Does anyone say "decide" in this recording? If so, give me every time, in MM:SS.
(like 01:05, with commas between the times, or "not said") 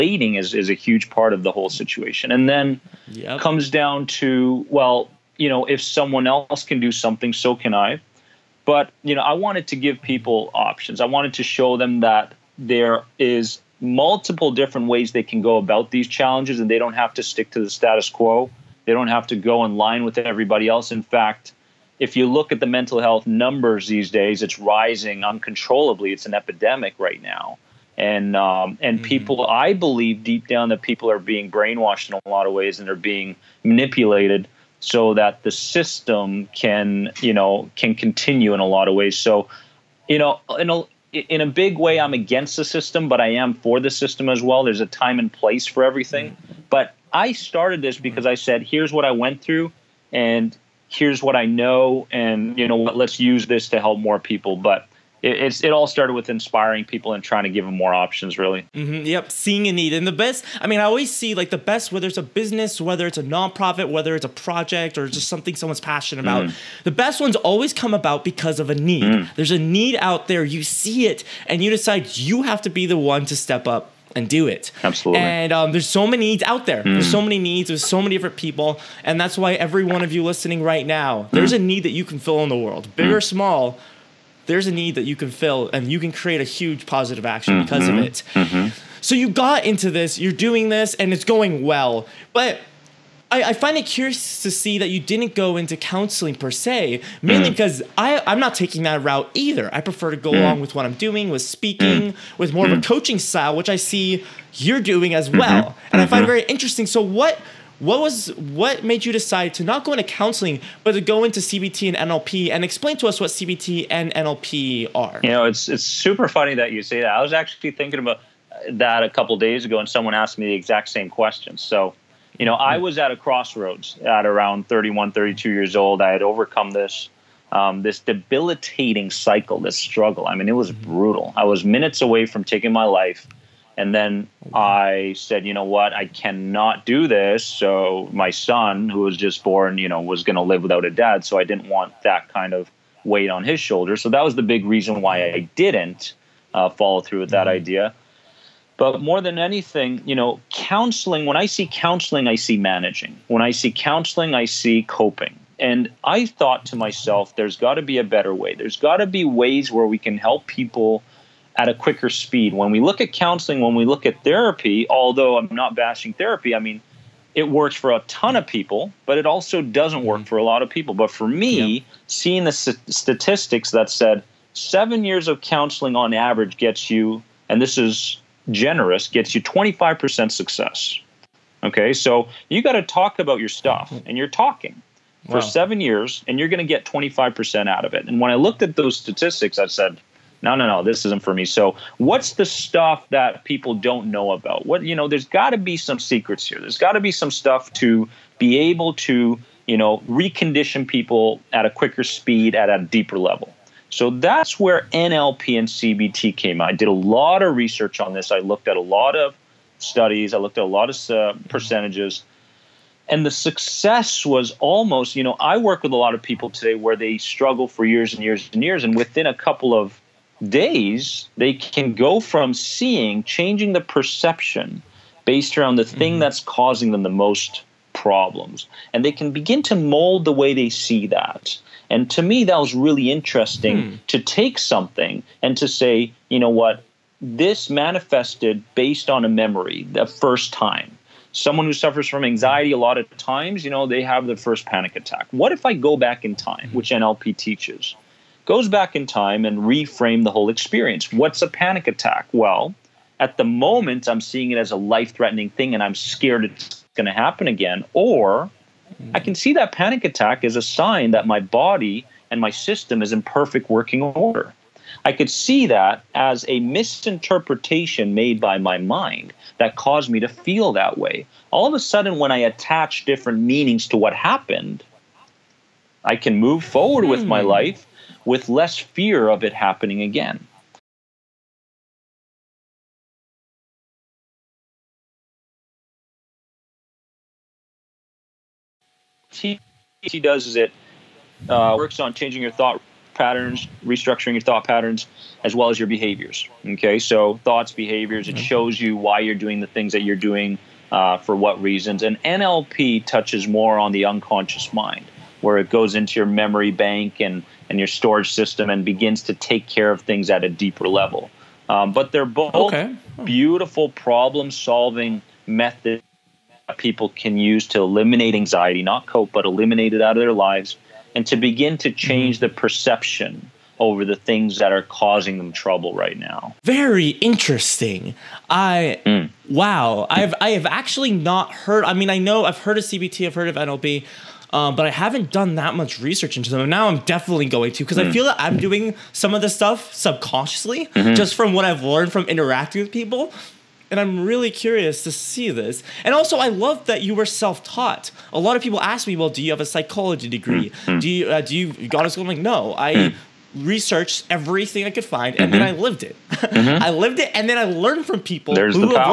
01:11, 01:49.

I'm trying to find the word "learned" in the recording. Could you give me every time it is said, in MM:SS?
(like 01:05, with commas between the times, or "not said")
05:41, 05:57.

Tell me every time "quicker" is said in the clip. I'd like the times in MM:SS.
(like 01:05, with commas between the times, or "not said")
02:41, 03:21.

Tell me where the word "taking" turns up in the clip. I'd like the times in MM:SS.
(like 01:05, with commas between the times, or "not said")
01:38, 02:12.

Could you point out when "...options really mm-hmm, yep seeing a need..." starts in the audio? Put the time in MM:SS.
00:57.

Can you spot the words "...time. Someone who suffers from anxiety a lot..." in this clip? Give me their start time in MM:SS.
04:00.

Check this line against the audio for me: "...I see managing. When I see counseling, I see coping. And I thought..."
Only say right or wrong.
right.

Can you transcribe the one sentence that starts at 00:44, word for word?
There's a time and place for everything.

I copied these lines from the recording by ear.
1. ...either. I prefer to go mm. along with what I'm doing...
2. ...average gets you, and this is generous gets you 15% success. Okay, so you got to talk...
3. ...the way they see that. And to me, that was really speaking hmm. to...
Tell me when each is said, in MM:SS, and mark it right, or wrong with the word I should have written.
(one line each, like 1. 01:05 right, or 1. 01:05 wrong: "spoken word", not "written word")
1. 01:39 right
2. 02:56 wrong: "25", not "15"
3. 03:50 wrong: "interesting", not "speaking".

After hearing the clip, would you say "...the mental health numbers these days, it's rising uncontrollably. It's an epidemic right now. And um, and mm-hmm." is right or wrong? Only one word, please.
right.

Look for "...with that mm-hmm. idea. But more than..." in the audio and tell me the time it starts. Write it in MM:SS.
02:27.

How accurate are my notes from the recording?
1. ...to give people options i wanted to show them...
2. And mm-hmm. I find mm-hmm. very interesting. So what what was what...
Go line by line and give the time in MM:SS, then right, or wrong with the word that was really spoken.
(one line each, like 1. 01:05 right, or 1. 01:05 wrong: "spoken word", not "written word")
1. 00:09 right
2. 01:45 right.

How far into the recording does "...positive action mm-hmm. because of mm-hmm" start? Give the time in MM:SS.
01:26.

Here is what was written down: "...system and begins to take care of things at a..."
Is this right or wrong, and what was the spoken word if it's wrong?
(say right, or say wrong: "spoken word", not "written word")
right.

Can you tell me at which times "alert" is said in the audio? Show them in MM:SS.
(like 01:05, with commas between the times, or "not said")
not said.